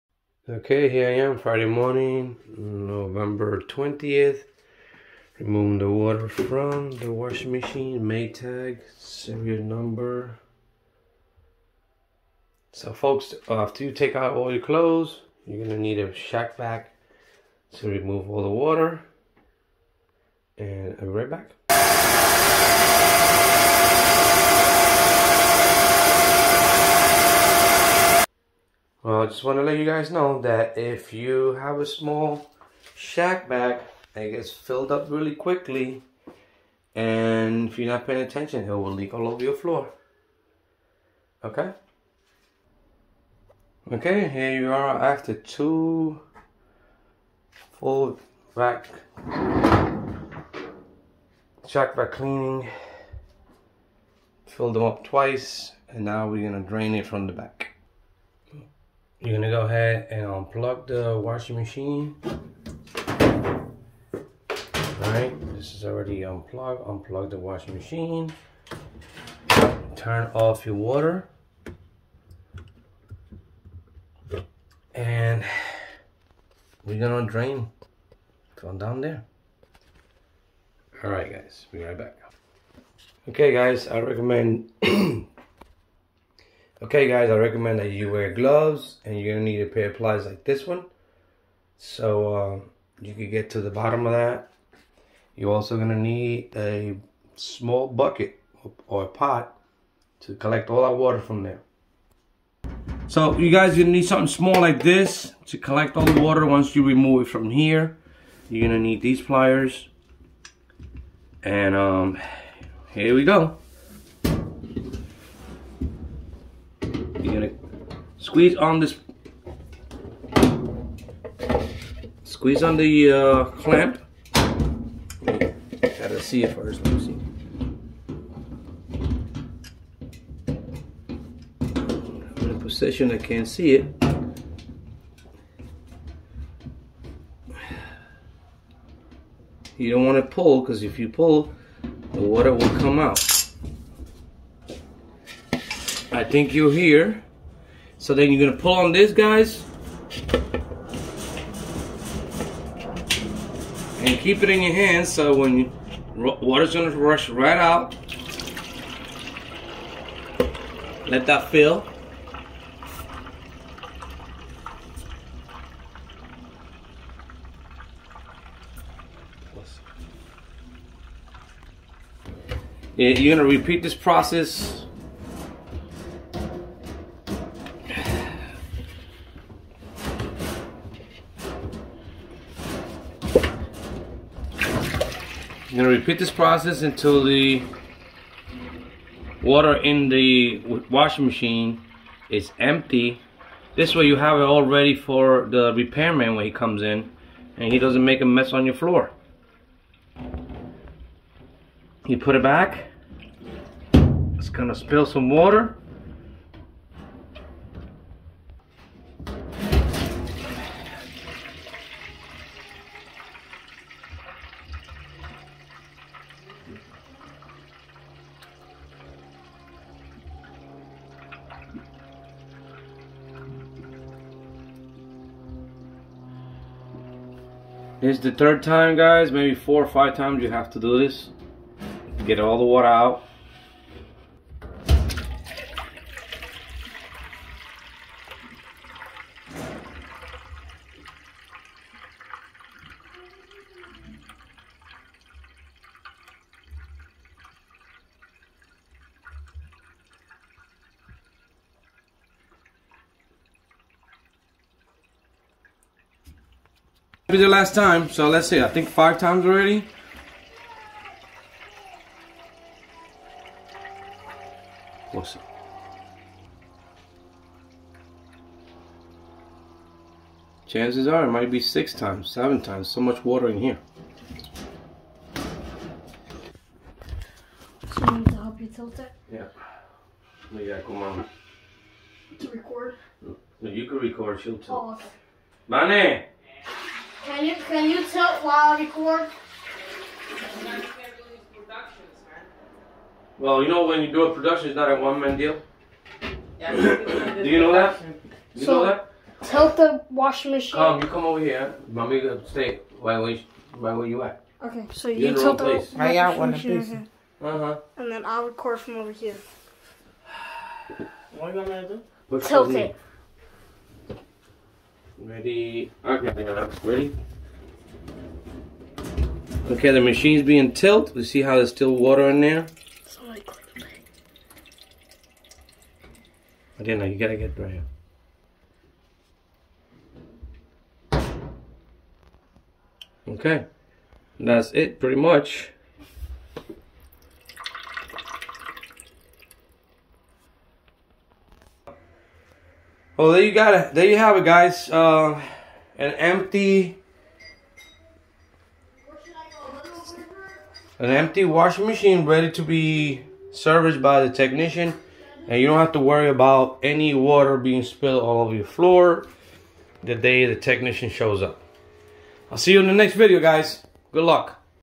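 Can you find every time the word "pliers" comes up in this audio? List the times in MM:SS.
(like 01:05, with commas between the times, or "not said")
01:29, 01:49.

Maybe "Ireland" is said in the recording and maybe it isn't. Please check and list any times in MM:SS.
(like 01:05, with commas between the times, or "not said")
not said.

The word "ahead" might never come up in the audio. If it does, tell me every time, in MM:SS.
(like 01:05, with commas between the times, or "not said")
00:59.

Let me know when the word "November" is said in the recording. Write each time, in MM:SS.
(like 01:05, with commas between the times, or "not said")
00:02.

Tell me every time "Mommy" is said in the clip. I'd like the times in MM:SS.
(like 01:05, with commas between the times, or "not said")
05:01.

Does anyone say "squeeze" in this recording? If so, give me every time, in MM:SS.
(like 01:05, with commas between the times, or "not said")
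01:58, 02:02.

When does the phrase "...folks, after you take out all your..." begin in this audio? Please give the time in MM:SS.
00:12.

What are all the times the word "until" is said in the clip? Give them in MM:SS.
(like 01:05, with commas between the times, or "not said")
03:06.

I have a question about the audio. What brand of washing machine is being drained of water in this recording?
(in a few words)
Maytag.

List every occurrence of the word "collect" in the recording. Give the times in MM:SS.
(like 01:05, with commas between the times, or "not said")
01:40, 01:45.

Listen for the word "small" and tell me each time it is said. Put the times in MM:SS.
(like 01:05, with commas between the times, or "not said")
00:31, 01:37, 01:44.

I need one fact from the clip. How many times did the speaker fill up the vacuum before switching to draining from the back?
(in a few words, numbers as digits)
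Twice.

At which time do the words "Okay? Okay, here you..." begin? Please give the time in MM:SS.
00:41.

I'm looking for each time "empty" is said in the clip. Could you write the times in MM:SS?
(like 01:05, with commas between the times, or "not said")
03:12, 05:46, 05:51.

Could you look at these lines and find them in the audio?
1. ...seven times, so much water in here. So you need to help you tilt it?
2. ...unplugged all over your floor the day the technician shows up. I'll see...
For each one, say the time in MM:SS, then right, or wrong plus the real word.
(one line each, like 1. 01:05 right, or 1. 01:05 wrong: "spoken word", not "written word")
1. 04:32 right
2. 05:57 wrong: "spilled", not "unplugged".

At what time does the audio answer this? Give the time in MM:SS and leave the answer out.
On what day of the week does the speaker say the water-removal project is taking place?
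00:01.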